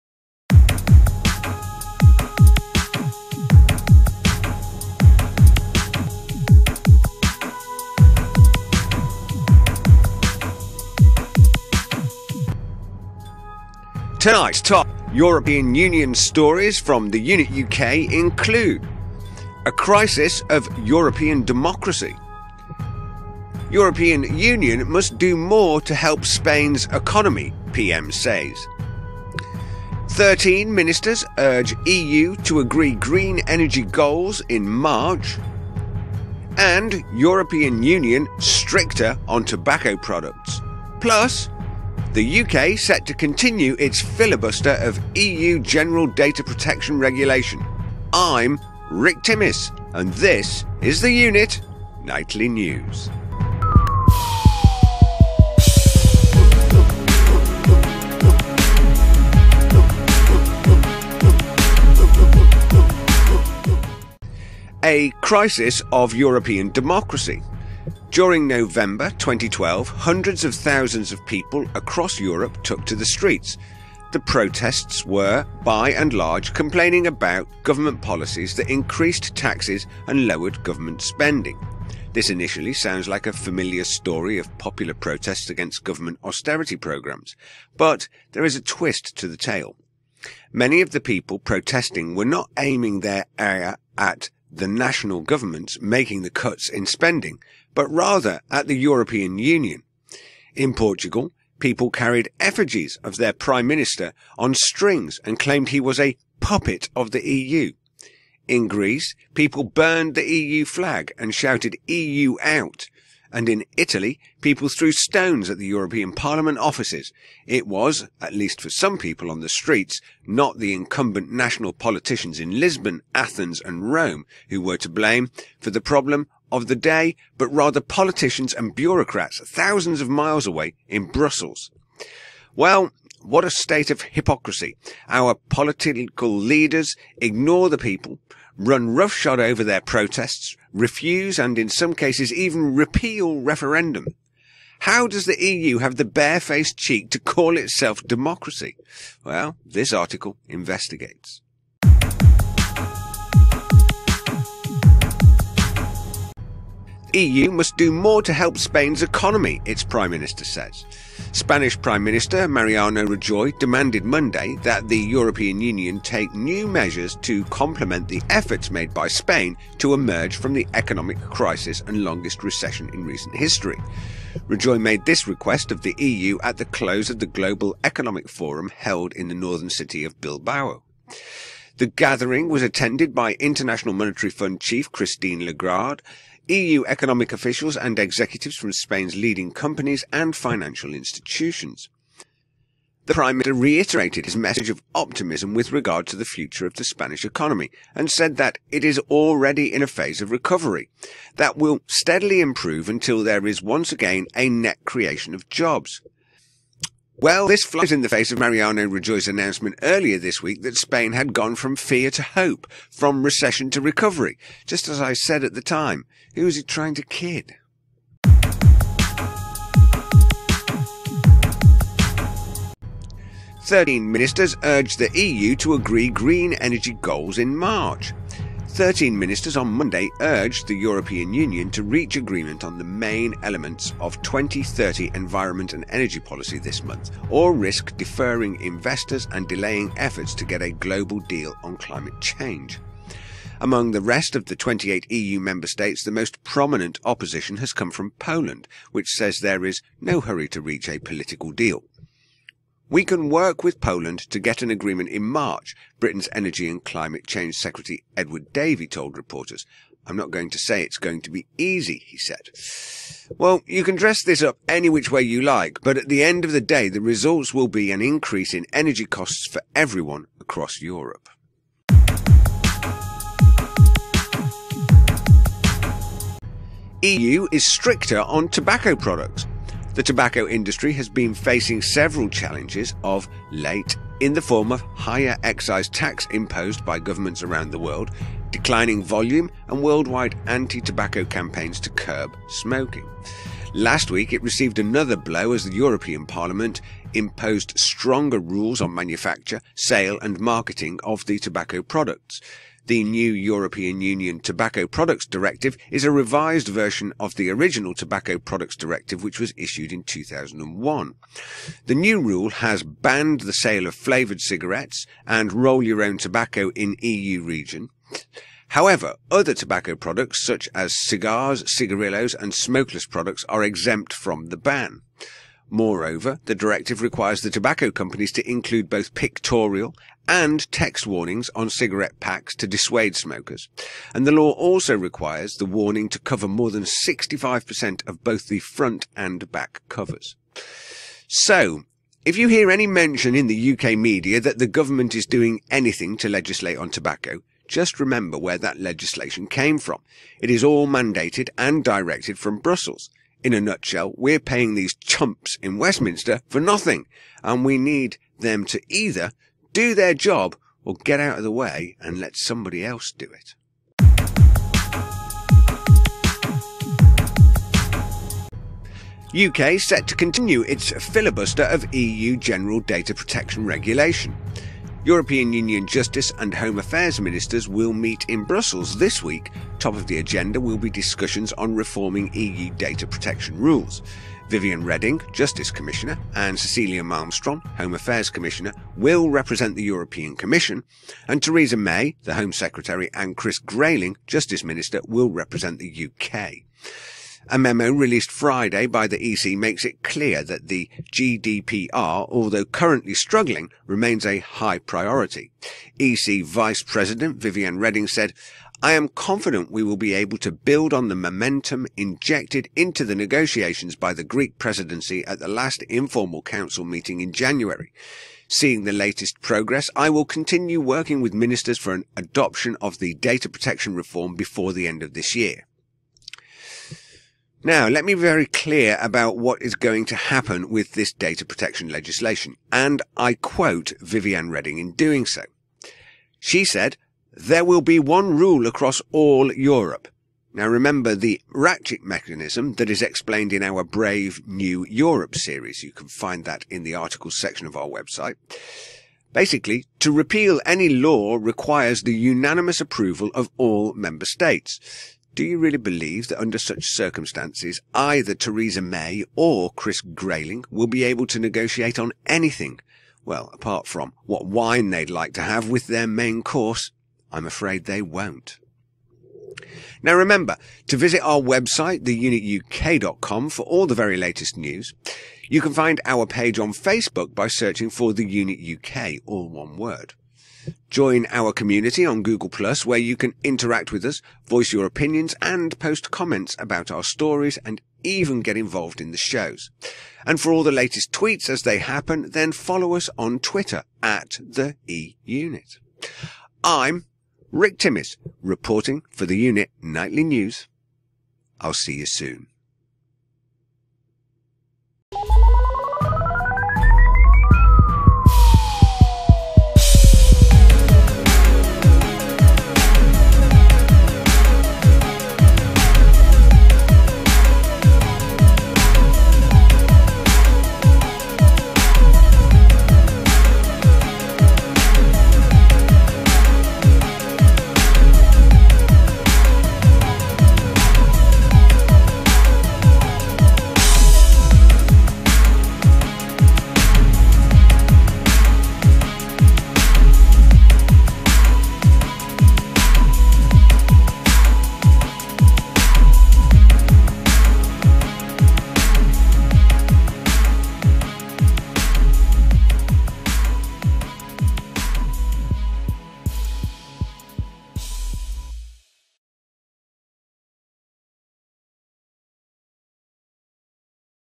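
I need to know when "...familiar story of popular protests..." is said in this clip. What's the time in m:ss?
1:23.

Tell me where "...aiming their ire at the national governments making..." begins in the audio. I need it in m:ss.
1:32.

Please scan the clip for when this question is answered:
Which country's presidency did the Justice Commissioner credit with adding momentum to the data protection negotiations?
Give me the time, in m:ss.
6:54.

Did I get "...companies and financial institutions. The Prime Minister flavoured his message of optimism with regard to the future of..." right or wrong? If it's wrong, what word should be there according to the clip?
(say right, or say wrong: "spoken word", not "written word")
wrong: "reiterated", not "flavoured".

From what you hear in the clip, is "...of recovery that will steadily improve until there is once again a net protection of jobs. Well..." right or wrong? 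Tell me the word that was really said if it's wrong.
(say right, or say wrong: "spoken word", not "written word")
wrong: "creation", not "protection".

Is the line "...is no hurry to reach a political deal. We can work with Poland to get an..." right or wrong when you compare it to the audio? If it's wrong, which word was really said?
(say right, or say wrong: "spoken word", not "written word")
right.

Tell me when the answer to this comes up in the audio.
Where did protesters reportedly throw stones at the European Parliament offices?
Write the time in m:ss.
1:53.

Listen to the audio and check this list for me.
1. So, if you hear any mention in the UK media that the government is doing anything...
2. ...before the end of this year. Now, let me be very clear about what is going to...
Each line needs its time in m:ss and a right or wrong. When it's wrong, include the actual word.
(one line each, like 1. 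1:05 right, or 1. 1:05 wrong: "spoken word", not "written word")
1. 5:41 right
2. 7:04 right.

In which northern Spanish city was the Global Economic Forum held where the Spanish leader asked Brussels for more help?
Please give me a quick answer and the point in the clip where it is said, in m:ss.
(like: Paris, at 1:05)
Bilbao, at 3:00.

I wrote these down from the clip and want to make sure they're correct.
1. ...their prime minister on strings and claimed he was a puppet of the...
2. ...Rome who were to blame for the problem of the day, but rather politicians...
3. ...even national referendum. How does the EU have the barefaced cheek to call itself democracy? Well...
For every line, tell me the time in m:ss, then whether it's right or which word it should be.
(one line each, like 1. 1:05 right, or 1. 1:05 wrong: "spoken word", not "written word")
1. 1:43 right
2. 2:03 right
3. 2:22 wrong: "repeal", not "national".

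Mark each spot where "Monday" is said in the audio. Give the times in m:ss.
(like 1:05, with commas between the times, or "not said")
2:44, 3:49.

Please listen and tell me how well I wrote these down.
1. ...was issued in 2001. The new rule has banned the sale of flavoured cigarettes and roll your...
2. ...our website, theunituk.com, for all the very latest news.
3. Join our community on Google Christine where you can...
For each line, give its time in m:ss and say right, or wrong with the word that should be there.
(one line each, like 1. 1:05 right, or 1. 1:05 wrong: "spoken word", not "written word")
1. 5:09 right
2. 7:51 right
3. 8:00 wrong: "Plus", not "Christine".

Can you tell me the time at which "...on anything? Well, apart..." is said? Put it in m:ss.
7:41.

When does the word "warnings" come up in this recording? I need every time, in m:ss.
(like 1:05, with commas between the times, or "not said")
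5:31, 5:35.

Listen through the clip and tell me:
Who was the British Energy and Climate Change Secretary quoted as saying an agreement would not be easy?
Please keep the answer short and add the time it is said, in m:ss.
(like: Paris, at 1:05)
Edward Davey, at 4:18.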